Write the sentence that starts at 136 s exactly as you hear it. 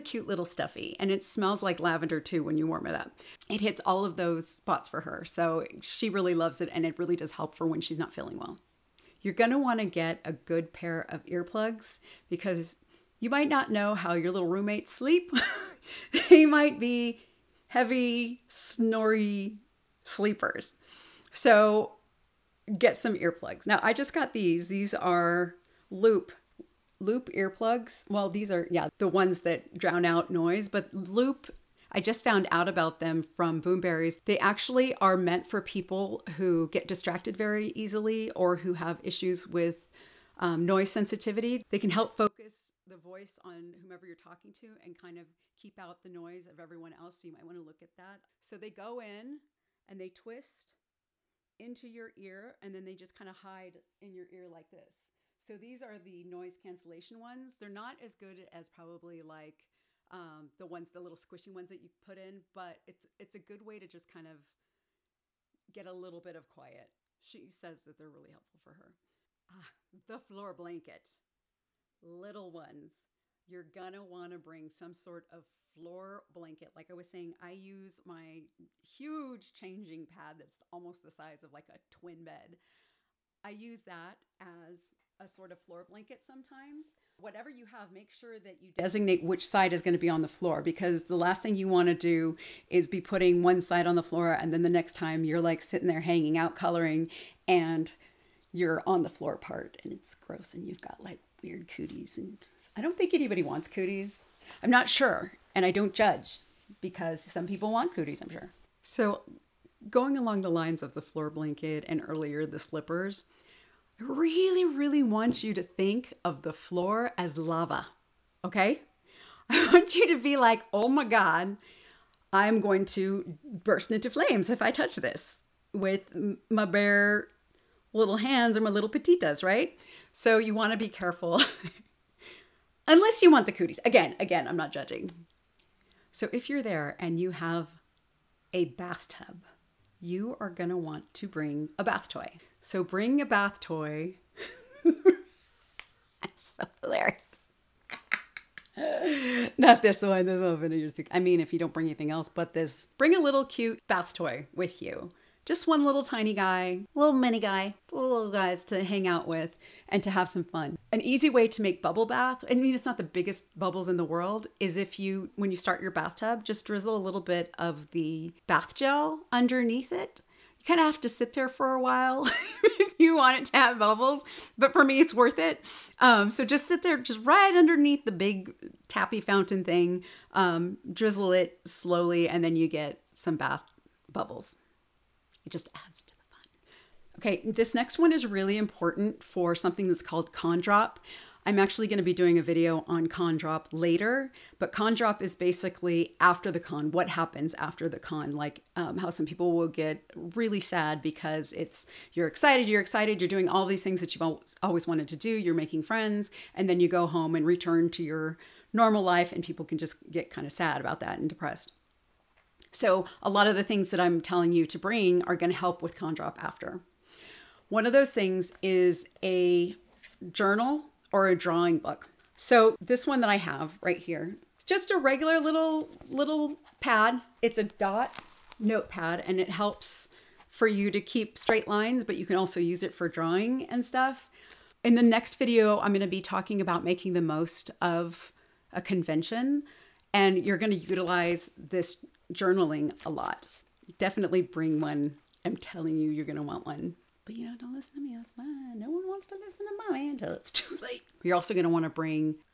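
So if you're there and you have a bathtub, you are going to want to bring a bath toy.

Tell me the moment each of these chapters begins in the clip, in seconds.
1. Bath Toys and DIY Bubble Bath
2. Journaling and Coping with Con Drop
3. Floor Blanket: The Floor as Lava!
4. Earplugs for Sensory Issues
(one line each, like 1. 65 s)
1. 135 s
2. 187 s
3. 69 s
4. 8 s.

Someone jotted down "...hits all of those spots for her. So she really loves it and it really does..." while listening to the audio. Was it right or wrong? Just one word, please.
right.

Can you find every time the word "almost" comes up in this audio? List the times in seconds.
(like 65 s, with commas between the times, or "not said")
80 s.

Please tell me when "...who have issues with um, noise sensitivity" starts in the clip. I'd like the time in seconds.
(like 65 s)
38 s.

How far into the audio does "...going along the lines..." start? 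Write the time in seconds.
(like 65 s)
109 s.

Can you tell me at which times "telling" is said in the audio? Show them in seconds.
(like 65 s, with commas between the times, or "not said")
214 s, 245 s.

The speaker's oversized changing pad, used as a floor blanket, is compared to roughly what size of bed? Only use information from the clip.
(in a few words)
Twin bed.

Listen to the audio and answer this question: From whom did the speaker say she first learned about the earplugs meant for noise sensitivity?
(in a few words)
Boomberries.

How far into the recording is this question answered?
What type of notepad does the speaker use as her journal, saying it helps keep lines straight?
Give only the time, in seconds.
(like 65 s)
227 s.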